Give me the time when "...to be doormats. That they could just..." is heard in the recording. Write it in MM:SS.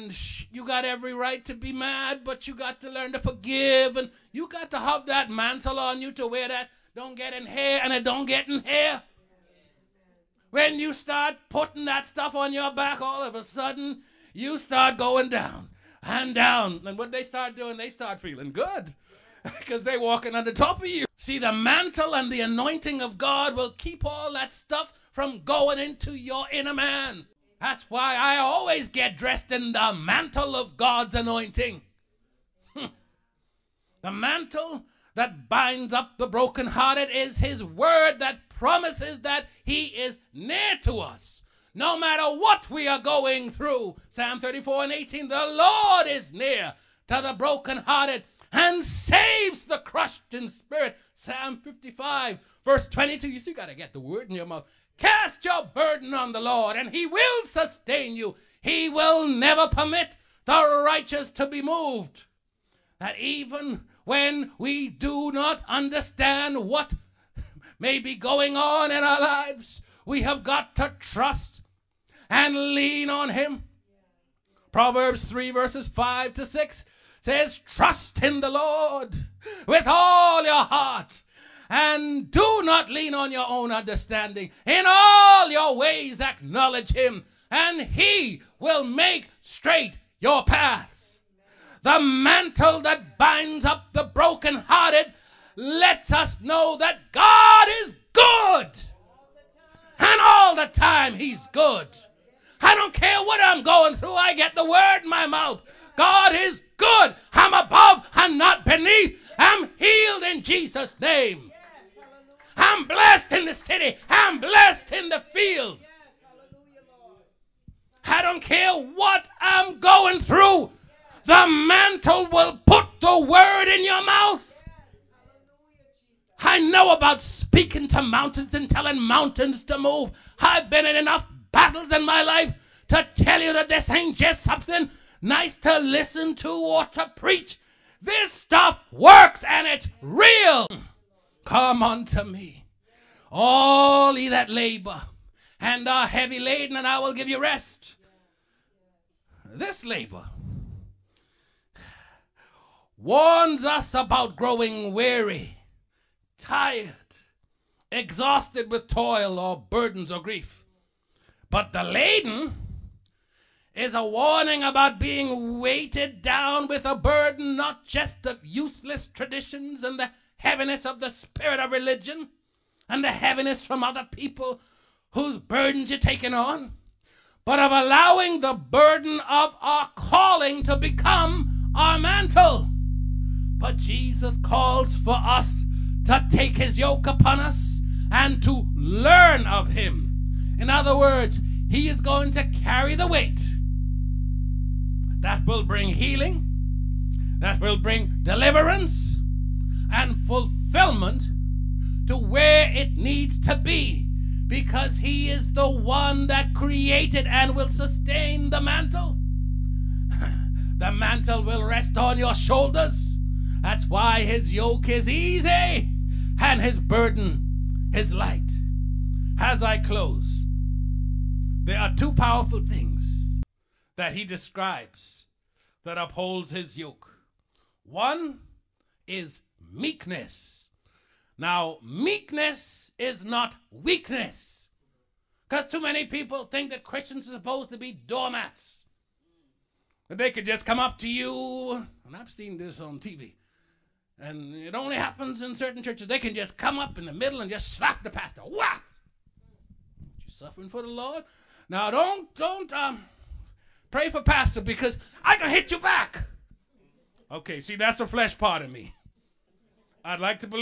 03:57.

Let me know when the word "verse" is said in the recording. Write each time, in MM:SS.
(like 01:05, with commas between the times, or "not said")
00:52, 01:15.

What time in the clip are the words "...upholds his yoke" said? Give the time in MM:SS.
03:45.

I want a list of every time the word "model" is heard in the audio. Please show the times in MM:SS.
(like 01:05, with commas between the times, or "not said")
not said.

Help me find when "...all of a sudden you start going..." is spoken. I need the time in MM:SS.
00:13.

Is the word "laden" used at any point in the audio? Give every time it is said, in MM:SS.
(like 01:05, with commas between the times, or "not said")
02:26, 02:41.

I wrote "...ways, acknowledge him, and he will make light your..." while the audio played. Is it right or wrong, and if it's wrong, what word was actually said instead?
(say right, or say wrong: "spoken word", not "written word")
wrong: "straight", not "light".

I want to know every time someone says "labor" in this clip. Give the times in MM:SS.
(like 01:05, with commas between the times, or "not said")
02:24, 02:29.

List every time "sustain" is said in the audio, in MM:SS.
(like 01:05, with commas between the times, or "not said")
00:57, 03:27.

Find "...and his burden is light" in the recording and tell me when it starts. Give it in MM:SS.
03:36.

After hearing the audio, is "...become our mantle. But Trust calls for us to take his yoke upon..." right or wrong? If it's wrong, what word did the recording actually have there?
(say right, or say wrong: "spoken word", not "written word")
wrong: "Jesus", not "Trust".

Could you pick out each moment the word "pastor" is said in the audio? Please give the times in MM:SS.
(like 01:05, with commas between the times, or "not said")
04:08, 04:14.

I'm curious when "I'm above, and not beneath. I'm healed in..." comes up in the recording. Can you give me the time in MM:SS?
01:47.